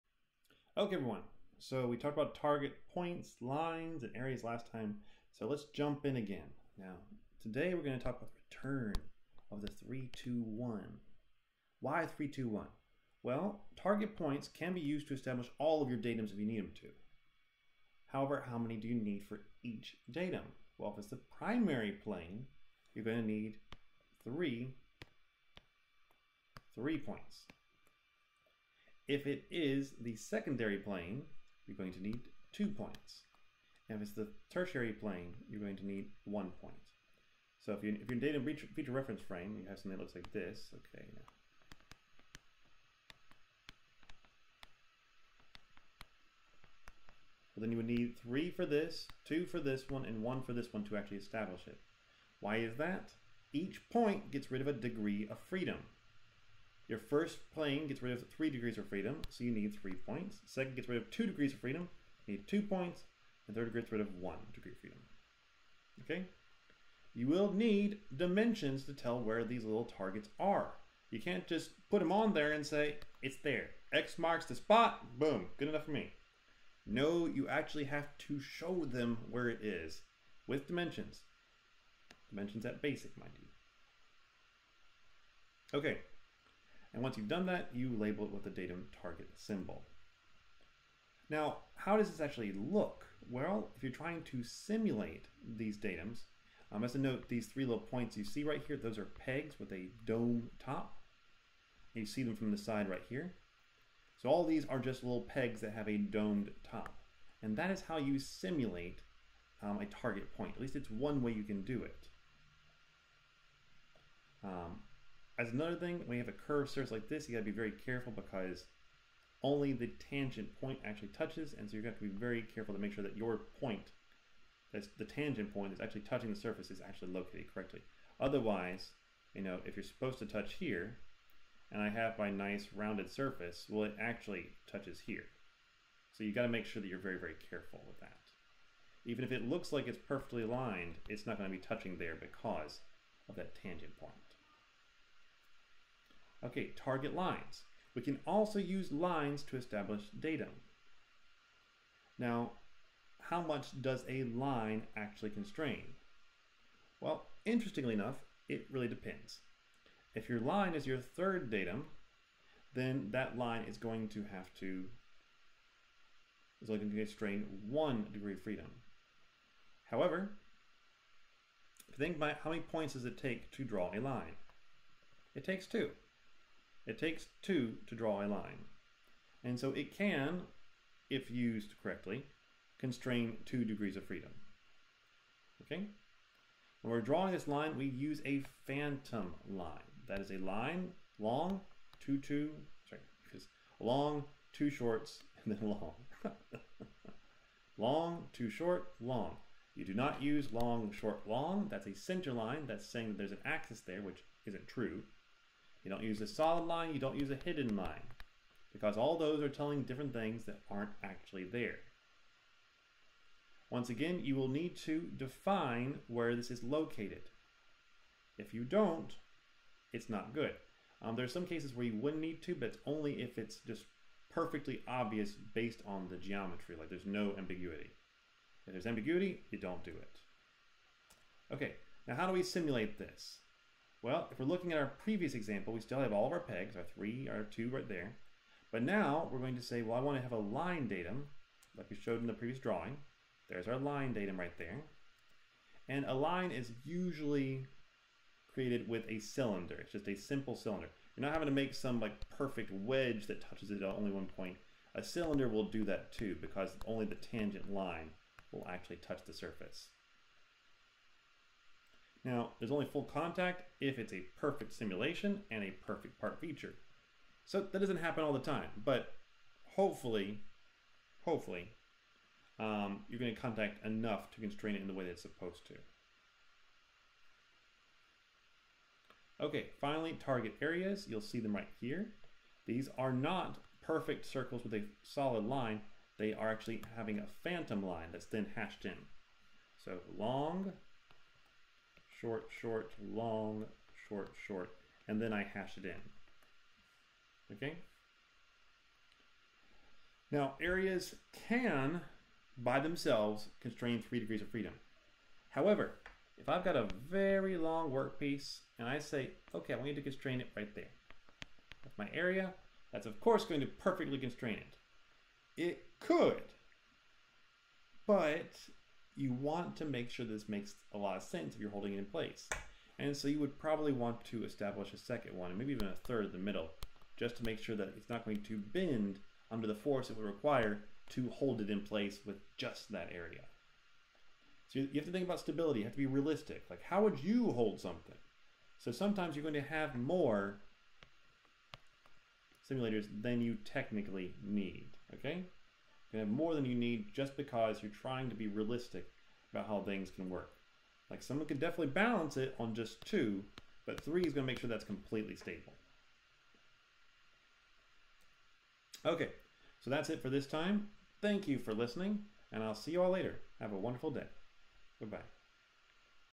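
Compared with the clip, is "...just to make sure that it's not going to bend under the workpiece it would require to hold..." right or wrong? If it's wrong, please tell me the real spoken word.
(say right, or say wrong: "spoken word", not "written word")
wrong: "force", not "workpiece".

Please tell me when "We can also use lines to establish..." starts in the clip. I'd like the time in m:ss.
2:27.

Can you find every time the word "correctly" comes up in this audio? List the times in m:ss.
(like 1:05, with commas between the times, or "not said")
2:07, 3:01.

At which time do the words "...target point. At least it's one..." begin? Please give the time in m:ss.
1:49.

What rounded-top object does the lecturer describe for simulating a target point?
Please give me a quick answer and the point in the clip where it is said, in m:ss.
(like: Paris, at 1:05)
pegs with a dome top, at 1:39.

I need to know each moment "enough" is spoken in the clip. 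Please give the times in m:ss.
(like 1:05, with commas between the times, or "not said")
1:15, 2:37, 4:33.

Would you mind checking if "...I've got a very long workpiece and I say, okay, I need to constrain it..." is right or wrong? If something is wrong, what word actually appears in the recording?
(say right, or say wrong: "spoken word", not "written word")
right.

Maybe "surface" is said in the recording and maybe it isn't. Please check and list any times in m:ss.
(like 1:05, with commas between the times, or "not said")
1:56, 2:06, 2:13, 4:19.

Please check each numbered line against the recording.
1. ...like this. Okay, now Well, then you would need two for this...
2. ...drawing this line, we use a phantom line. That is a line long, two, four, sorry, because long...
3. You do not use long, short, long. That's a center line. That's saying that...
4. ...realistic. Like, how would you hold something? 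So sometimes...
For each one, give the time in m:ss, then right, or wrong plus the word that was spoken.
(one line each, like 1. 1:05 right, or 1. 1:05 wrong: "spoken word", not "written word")
1. 0:40 wrong: "three", not "two"
2. 3:07 wrong: "two", not "four"
3. 3:19 right
4. 5:36 right.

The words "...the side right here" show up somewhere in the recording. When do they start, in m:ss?
1:42.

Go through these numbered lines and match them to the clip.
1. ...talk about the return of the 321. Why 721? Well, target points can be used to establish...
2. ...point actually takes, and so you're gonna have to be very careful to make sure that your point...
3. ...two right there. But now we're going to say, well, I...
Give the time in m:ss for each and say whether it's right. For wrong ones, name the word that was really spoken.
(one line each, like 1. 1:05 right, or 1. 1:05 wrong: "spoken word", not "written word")
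1. 0:08 wrong: "321", not "721"
2. 2:00 wrong: "touches", not "takes"
3. 3:57 right.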